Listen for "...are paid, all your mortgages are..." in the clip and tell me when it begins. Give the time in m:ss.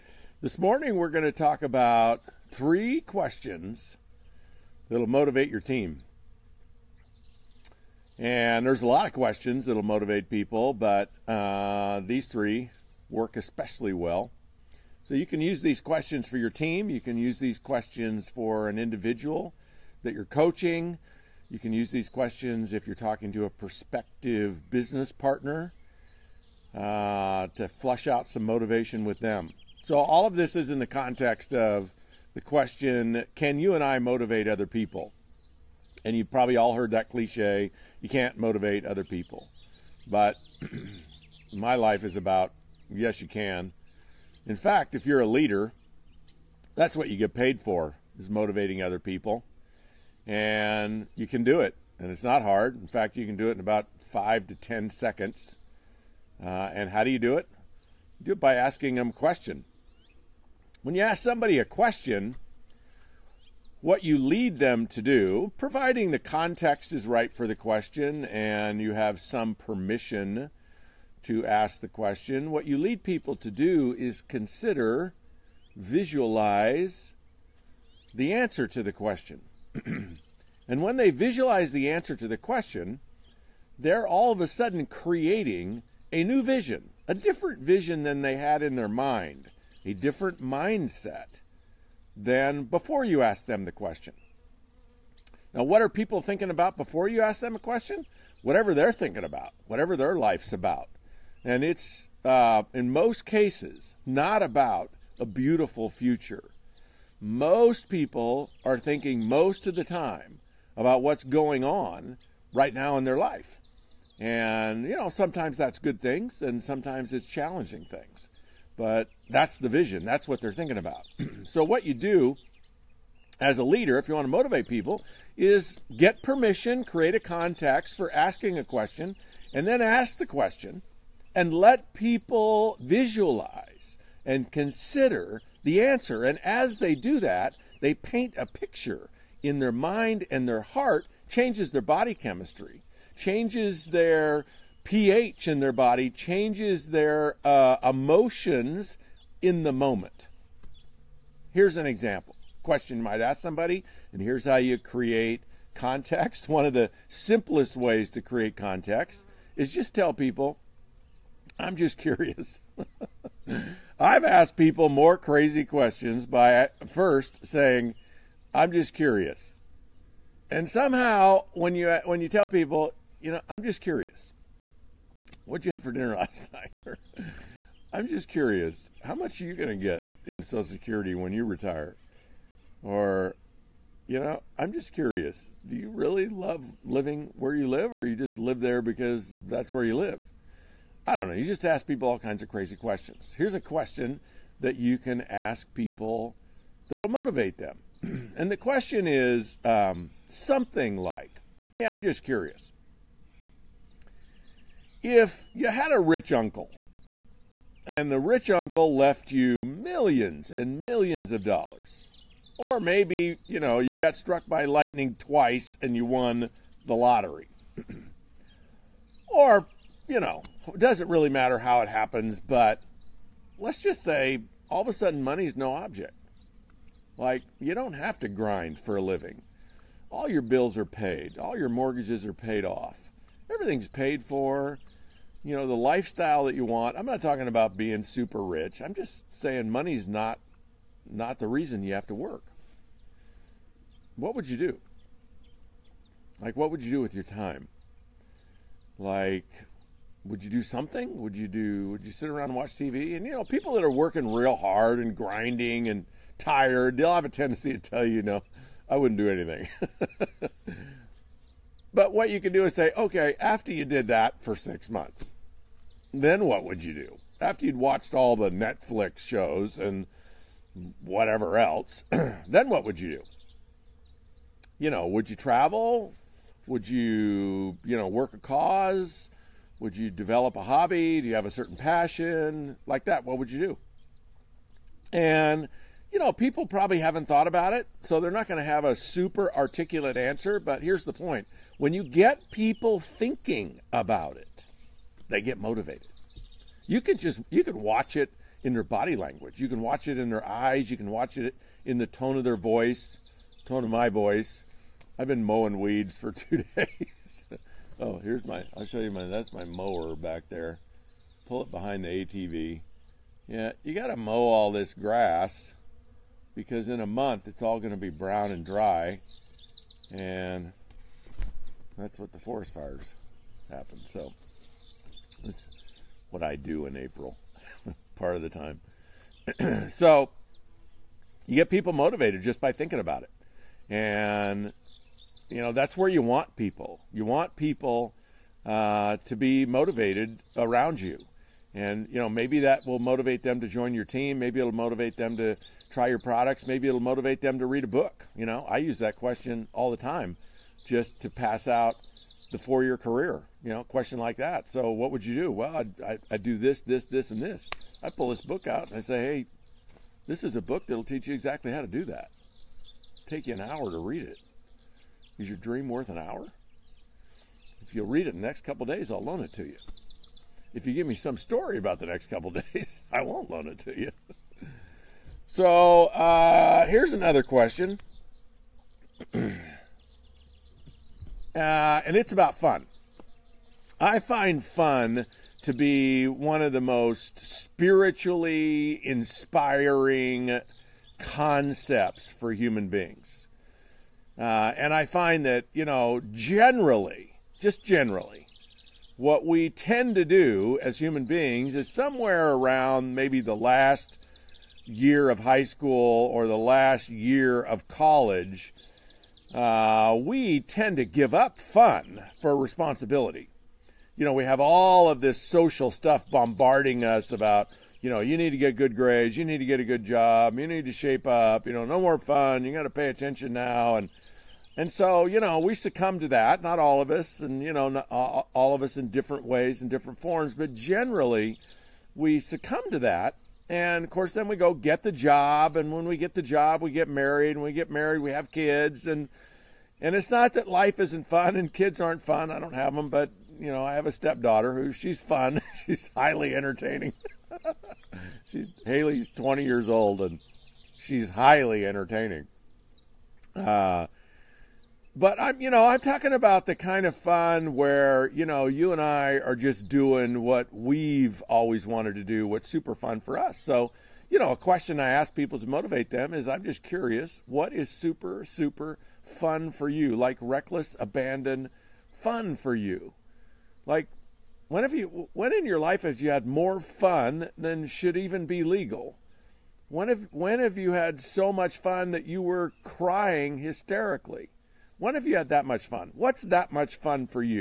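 3:50.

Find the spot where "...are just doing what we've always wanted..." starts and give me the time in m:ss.
7:39.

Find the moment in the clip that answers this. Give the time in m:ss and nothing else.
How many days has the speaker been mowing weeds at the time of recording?
5:06.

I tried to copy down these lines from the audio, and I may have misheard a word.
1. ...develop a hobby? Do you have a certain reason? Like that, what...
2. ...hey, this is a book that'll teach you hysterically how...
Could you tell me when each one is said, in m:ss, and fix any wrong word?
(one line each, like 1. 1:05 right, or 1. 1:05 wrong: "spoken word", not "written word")
1. 4:40 wrong: "passion", not "reason"
2. 5:59 wrong: "exactly", not "hysterically".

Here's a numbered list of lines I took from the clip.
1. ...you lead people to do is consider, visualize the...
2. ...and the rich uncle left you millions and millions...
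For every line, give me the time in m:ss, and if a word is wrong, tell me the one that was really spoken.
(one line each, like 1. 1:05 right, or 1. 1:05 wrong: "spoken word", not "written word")
1. 1:12 right
2. 3:27 right.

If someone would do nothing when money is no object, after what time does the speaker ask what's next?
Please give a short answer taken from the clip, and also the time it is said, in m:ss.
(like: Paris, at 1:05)
6 months, at 4:24.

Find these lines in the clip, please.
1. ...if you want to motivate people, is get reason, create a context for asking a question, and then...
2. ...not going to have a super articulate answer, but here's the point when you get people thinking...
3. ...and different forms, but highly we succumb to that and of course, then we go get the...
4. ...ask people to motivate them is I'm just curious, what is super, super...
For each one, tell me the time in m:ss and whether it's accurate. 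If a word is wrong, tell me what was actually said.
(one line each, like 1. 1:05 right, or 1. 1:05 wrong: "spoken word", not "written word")
1. 2:03 wrong: "permission", not "reason"
2. 4:48 right
3. 7:09 wrong: "generally", not "highly"
4. 7:45 right.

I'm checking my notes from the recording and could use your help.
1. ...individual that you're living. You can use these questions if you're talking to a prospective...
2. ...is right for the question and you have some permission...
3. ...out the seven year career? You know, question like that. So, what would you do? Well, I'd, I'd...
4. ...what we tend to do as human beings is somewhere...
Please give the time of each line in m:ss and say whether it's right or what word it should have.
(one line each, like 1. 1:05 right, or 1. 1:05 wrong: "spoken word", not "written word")
1. 0:18 wrong: "coaching", not "living"
2. 1:06 right
3. 5:51 wrong: "four", not "seven"
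4. 6:39 right.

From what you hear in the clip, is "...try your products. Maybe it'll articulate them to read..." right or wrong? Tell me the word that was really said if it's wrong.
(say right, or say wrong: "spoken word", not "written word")
wrong: "motivate", not "articulate".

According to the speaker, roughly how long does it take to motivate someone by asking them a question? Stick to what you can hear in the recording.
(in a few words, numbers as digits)
5 to 10 seconds.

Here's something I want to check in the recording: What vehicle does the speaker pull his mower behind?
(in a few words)
ATV.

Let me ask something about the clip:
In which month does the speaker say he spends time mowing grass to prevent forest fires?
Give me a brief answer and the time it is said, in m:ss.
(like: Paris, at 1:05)
April, at 5:26.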